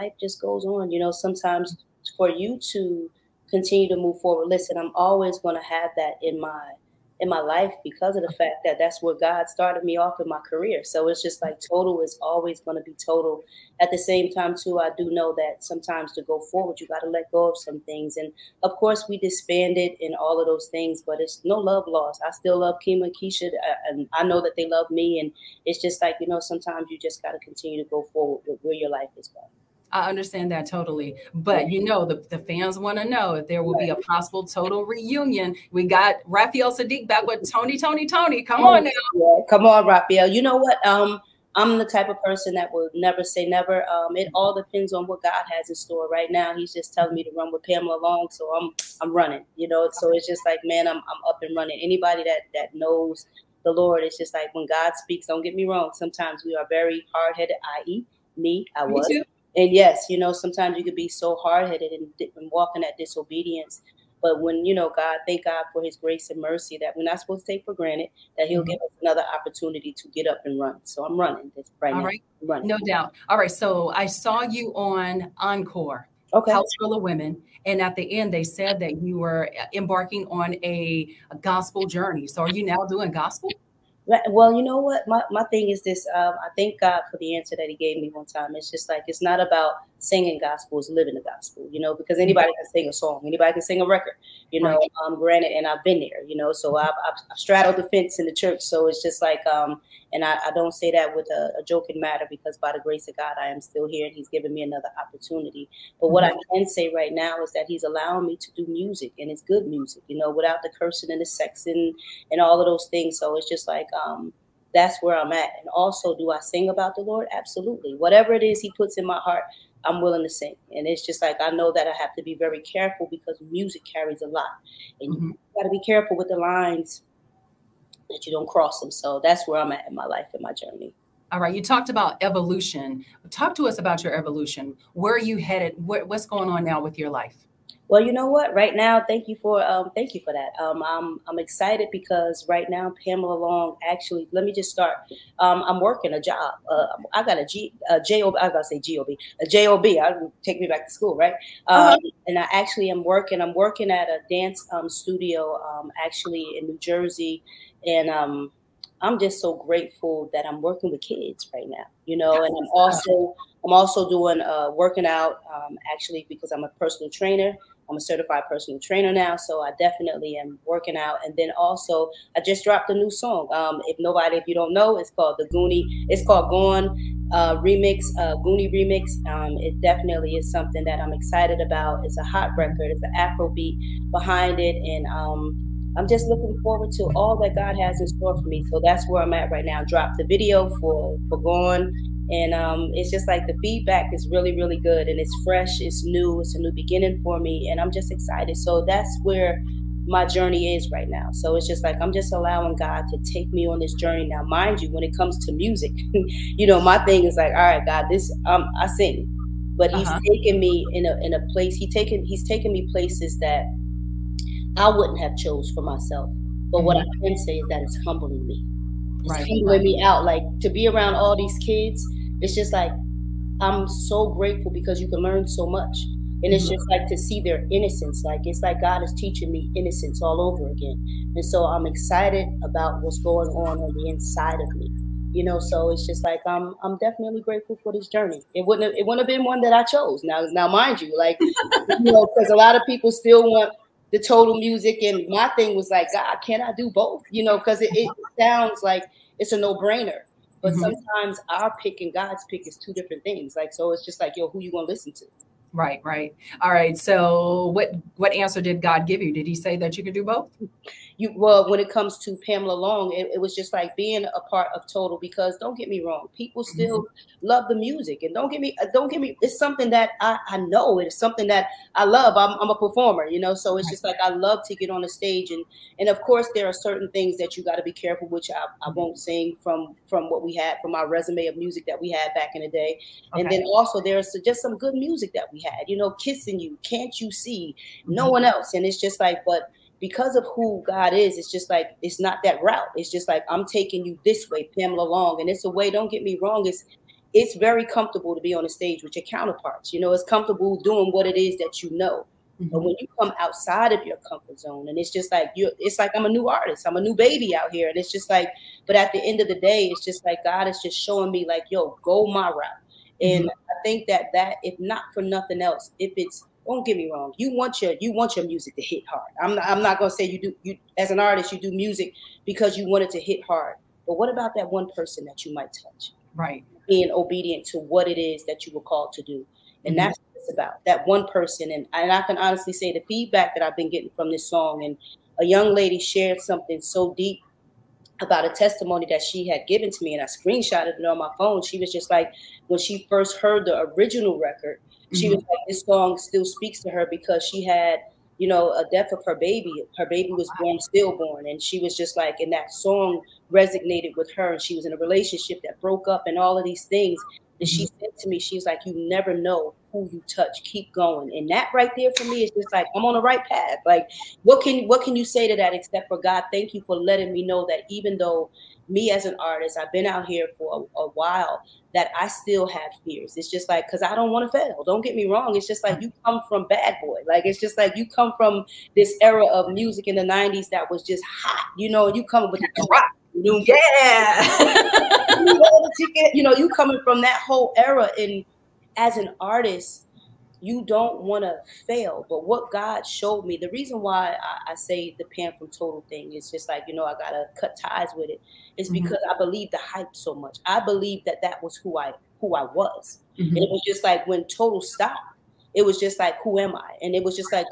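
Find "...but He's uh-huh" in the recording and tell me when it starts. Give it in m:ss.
3:29.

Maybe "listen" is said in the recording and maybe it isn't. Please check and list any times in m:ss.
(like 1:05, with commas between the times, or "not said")
0:04, 4:14.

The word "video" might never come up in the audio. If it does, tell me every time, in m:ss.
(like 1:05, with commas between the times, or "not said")
3:10.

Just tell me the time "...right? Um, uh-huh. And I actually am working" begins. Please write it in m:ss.
2:31.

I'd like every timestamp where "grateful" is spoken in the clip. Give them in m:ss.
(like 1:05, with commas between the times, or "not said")
2:39, 3:44, 3:57.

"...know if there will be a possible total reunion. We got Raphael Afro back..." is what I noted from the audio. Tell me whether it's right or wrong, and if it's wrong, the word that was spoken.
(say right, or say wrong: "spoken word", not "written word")
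wrong: "Saadiq", not "Afro".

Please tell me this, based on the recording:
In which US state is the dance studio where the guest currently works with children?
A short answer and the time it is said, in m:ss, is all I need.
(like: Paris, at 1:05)
New Jersey, at 2:36.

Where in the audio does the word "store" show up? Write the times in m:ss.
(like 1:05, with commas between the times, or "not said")
0:45, 3:08.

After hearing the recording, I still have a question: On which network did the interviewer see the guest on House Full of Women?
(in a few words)
Encore.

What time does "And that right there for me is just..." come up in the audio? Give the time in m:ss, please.
6:01.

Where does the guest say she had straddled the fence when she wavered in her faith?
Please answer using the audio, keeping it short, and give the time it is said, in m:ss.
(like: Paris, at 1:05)
In the church, at 1:38.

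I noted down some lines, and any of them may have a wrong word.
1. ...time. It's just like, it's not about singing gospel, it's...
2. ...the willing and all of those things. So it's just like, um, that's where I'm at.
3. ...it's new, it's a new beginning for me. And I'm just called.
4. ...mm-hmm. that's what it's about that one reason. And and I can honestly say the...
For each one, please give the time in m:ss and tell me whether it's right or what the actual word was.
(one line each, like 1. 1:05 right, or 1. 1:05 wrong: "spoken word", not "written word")
1. 1:28 right
2. 1:51 wrong: "sexing", not "willing"
3. 3:15 wrong: "excited", not "called"
4. 5:29 wrong: "person", not "reason".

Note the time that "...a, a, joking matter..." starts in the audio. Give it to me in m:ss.
1:41.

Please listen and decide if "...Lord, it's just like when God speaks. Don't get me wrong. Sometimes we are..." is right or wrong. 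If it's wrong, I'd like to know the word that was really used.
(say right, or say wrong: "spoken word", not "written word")
right.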